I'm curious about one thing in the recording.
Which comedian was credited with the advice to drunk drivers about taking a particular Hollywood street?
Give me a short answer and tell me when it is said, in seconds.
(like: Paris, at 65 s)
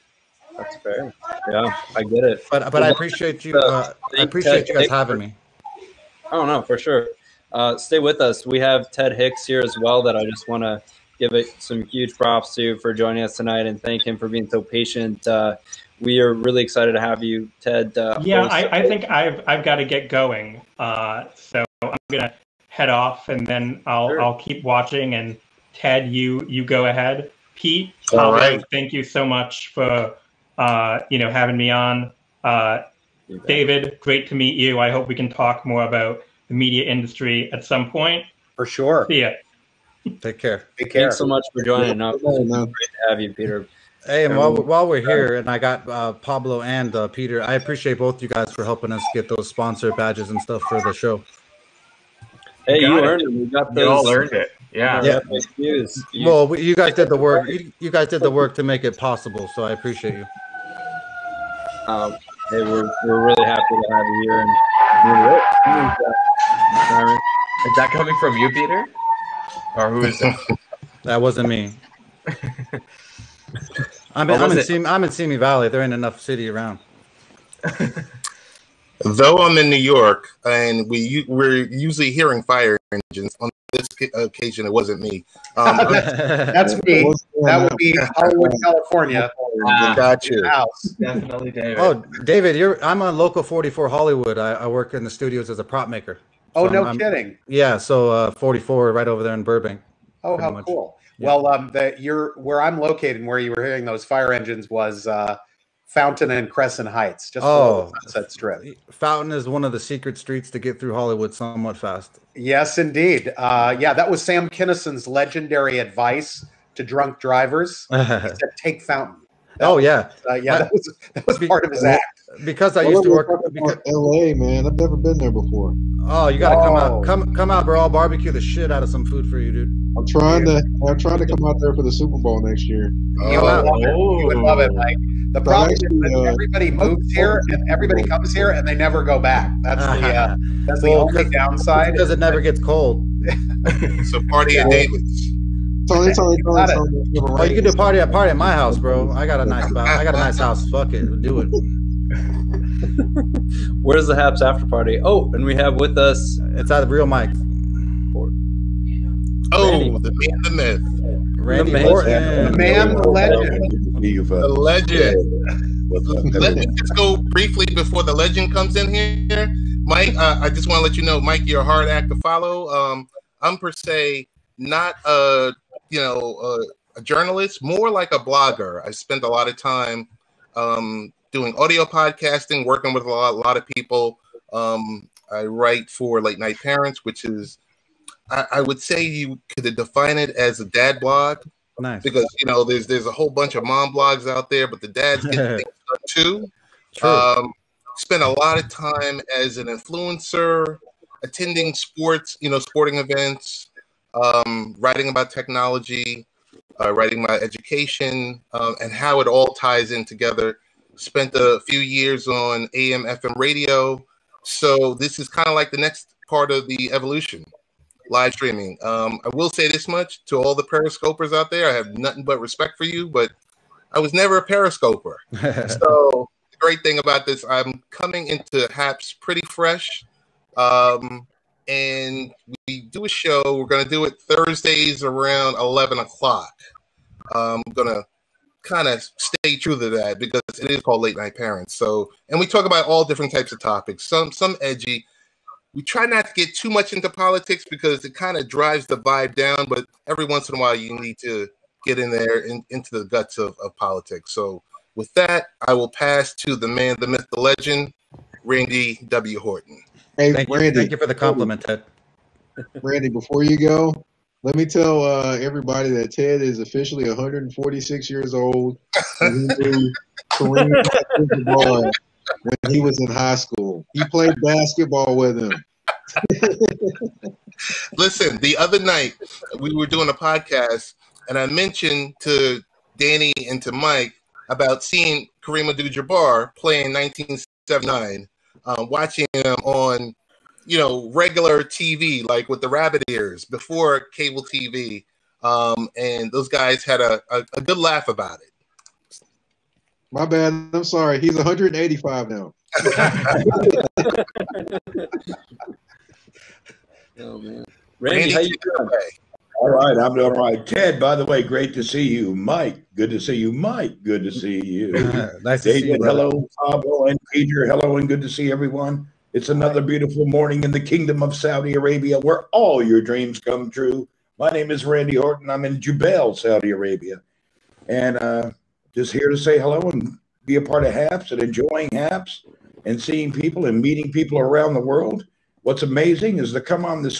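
Sam Kinison, at 114 s.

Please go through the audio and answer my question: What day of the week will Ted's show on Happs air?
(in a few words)
Thursdays.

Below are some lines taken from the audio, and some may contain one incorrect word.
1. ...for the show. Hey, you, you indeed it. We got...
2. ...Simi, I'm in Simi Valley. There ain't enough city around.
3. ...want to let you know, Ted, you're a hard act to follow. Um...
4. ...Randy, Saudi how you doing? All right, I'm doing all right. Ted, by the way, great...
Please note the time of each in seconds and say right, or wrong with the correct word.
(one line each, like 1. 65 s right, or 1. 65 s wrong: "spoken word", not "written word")
1. 50 s wrong: "earned", not "indeed"
2. 74 s right
3. 170 s wrong: "Mike", not "Ted"
4. 307 s wrong: "Randy", not "Saudi".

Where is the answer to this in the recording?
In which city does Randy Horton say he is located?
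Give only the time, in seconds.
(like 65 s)
325 s.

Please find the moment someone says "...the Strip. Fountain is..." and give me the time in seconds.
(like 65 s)
108 s.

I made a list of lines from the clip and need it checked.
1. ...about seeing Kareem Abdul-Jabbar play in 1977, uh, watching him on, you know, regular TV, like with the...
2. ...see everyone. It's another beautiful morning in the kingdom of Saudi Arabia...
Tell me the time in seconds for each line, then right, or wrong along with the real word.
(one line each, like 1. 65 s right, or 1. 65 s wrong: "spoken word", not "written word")
1. 284 s wrong: "1979", not "1977"
2. 318 s right.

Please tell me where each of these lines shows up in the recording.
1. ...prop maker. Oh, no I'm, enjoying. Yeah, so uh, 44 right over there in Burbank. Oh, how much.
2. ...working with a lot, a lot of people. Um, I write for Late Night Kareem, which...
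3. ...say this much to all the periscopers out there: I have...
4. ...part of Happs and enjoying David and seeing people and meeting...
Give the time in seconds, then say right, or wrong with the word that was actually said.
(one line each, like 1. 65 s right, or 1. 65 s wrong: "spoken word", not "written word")
1. 95 s wrong: "kidding", not "enjoying"
2. 182 s wrong: "Parents", not "Kareem"
3. 219 s right
4. 330 s wrong: "Happs", not "David".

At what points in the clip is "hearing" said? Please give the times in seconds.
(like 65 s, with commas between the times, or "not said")
82 s, 103 s.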